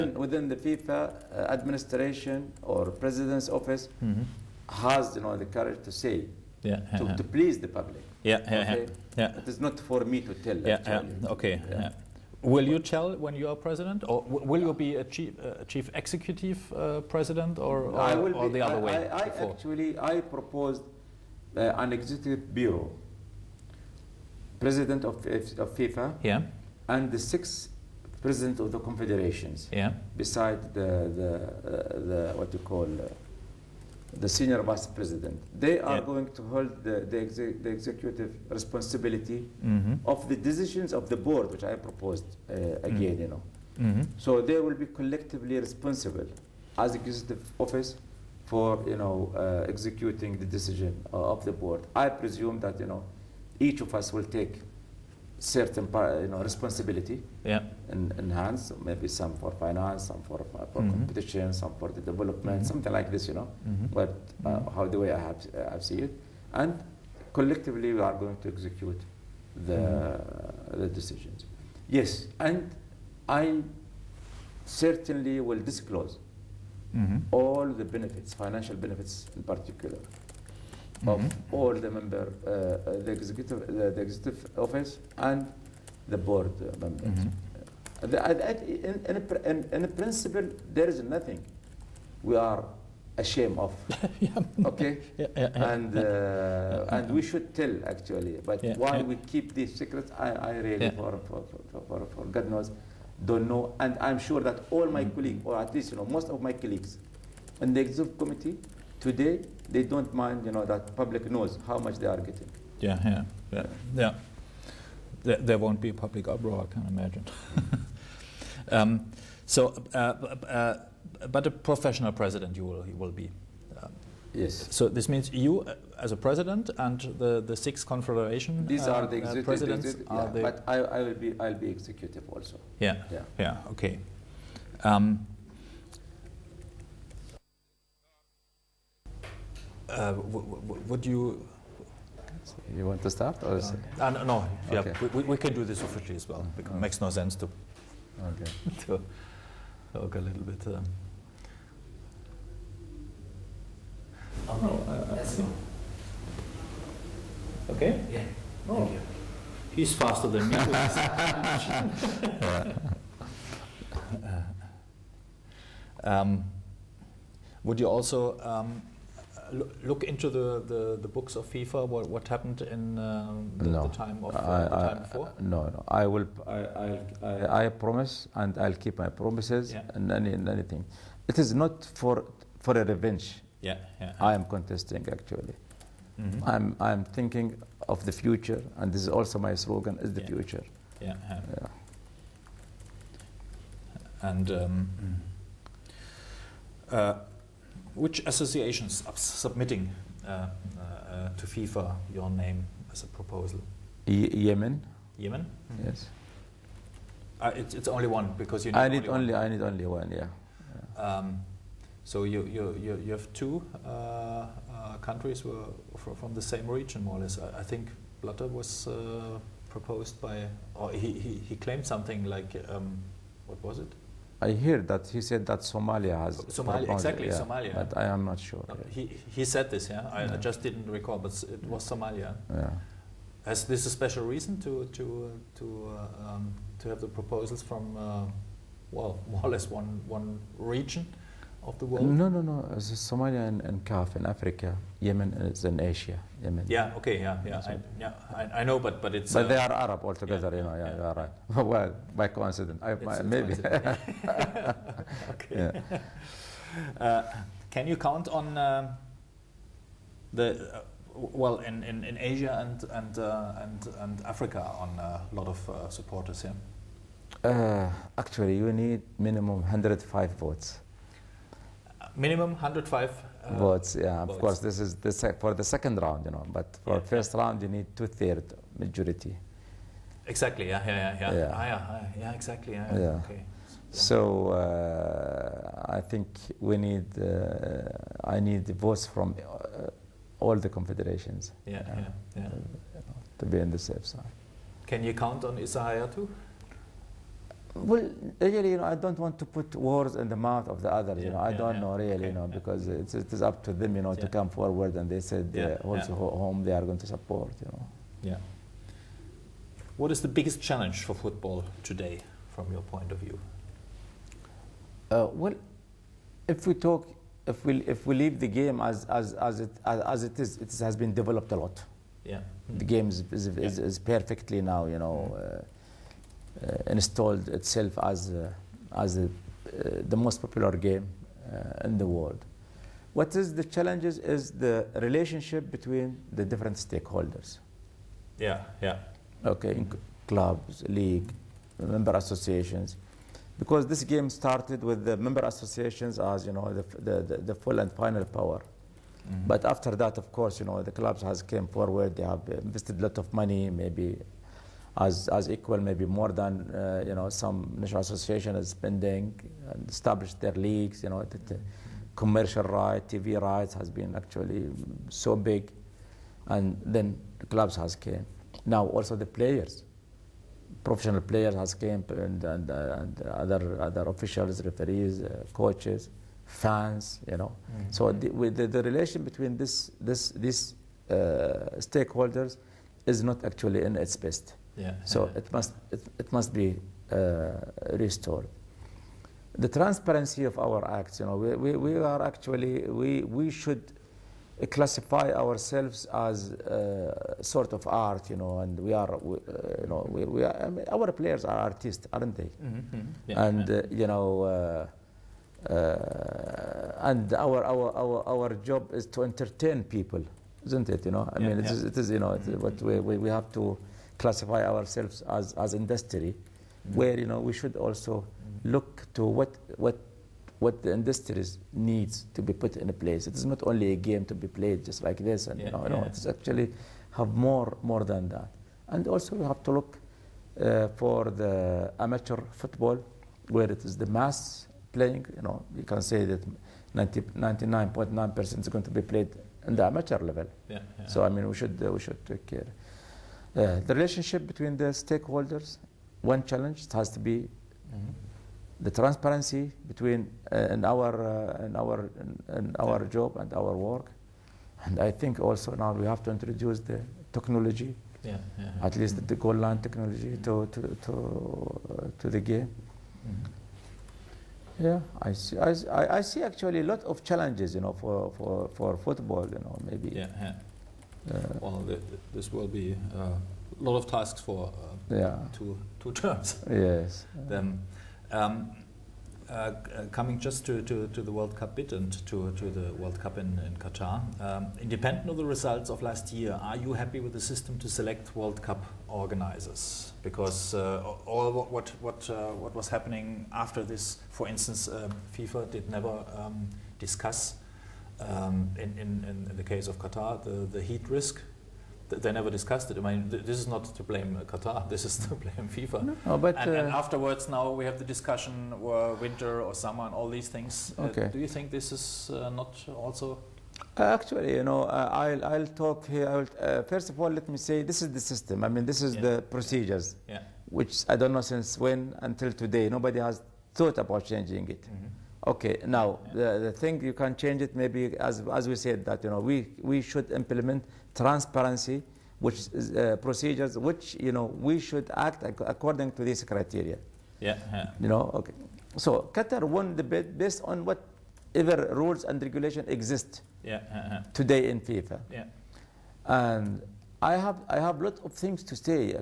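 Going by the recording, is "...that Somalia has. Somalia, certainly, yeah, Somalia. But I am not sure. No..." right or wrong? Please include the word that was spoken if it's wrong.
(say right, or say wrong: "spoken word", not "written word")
wrong: "exactly", not "certainly".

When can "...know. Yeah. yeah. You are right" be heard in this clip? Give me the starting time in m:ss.
4:10.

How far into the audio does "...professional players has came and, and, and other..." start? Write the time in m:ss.
6:10.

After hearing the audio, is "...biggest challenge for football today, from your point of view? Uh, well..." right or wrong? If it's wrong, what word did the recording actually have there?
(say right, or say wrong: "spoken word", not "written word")
right.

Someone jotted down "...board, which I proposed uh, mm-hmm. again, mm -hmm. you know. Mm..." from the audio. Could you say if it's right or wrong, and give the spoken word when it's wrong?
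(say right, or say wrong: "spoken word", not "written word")
right.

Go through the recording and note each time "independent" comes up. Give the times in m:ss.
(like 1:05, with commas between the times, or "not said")
8:04.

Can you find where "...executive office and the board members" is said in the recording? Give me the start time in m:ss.
1:24.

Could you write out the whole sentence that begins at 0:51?
I presume that, you know, each of us will take certain you know, responsibility yeah.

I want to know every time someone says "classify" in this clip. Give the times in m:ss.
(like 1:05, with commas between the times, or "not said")
6:34, 6:54.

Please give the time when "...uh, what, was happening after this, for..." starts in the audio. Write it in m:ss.
8:12.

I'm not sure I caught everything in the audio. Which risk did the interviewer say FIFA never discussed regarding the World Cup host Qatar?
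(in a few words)
Heat risk.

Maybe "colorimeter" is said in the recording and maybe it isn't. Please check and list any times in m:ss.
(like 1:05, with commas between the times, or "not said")
not said.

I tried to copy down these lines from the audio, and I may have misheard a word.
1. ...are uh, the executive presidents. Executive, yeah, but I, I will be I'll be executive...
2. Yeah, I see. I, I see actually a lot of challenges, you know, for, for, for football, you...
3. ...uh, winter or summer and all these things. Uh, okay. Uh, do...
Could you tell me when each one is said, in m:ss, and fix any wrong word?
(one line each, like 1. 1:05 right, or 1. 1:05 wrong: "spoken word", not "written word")
1. 2:08 right
2. 7:44 right
3. 8:28 right.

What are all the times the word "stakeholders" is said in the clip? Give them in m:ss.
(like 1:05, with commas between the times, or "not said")
5:36, 6:21, 7:24.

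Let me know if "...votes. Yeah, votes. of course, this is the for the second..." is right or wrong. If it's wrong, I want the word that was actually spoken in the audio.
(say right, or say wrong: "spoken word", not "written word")
right.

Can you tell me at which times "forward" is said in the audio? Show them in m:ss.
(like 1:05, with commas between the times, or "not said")
5:04, 5:51.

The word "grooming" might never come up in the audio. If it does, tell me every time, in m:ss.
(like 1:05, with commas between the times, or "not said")
not said.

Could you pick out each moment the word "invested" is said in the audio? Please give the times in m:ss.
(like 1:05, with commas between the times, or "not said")
5:52.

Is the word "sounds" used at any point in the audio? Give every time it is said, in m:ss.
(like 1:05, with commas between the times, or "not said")
not said.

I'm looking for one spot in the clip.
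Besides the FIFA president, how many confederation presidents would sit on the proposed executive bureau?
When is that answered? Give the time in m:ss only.
0:27.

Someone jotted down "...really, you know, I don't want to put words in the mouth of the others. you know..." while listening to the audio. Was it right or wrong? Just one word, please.
right.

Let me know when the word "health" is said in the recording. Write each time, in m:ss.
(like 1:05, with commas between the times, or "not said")
not said.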